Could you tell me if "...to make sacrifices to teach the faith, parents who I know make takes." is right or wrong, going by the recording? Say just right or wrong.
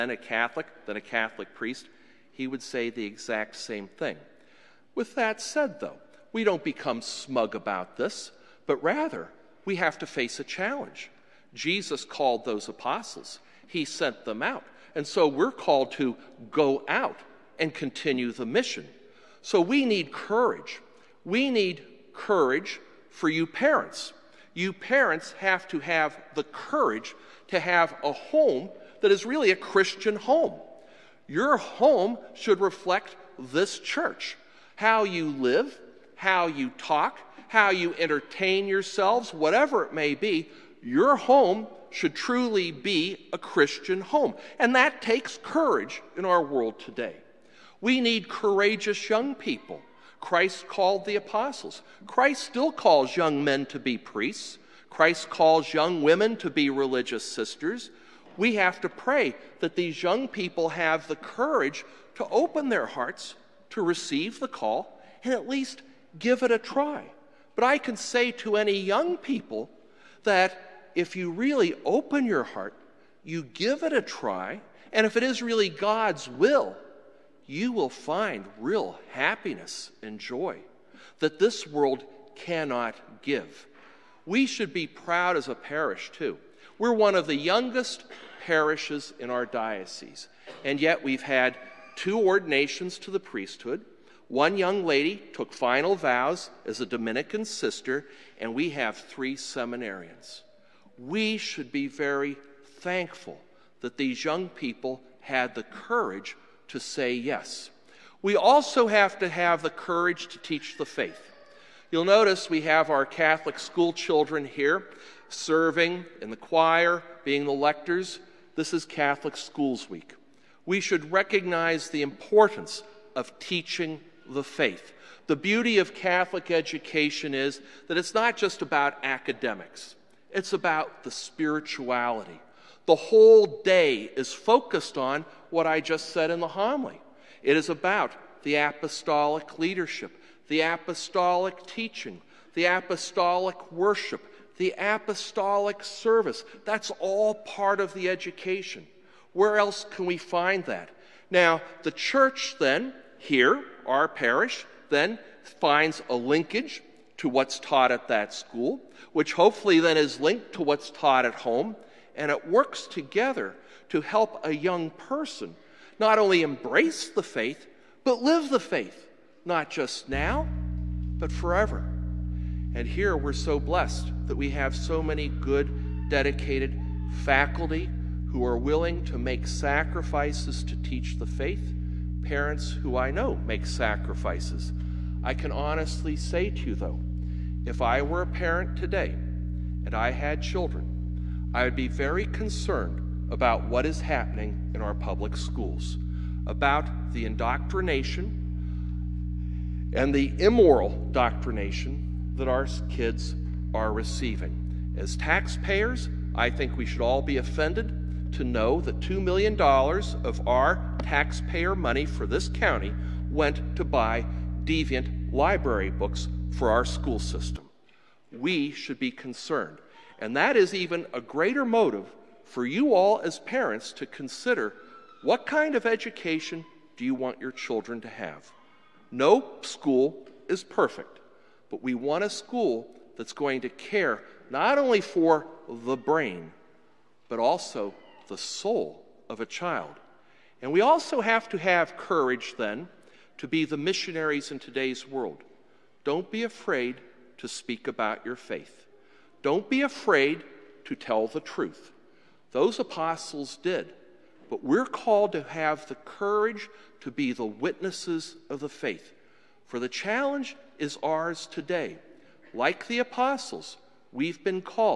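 wrong.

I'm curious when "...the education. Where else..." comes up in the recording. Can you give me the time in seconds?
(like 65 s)
147 s.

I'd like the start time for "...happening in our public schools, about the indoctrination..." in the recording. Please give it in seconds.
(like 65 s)
194 s.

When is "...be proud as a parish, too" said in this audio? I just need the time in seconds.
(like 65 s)
84 s.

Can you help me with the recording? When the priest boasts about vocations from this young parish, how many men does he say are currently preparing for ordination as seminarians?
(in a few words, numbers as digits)
3.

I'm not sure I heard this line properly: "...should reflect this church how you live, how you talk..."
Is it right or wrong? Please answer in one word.
right.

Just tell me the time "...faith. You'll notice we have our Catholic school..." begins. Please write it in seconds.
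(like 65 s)
110 s.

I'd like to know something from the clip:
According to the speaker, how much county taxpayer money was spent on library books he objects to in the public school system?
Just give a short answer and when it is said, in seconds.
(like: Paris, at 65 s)
$2 million, at 209 s.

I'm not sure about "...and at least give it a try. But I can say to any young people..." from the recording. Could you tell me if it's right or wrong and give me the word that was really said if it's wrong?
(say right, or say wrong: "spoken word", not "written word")
right.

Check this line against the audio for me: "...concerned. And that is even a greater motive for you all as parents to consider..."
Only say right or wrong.
right.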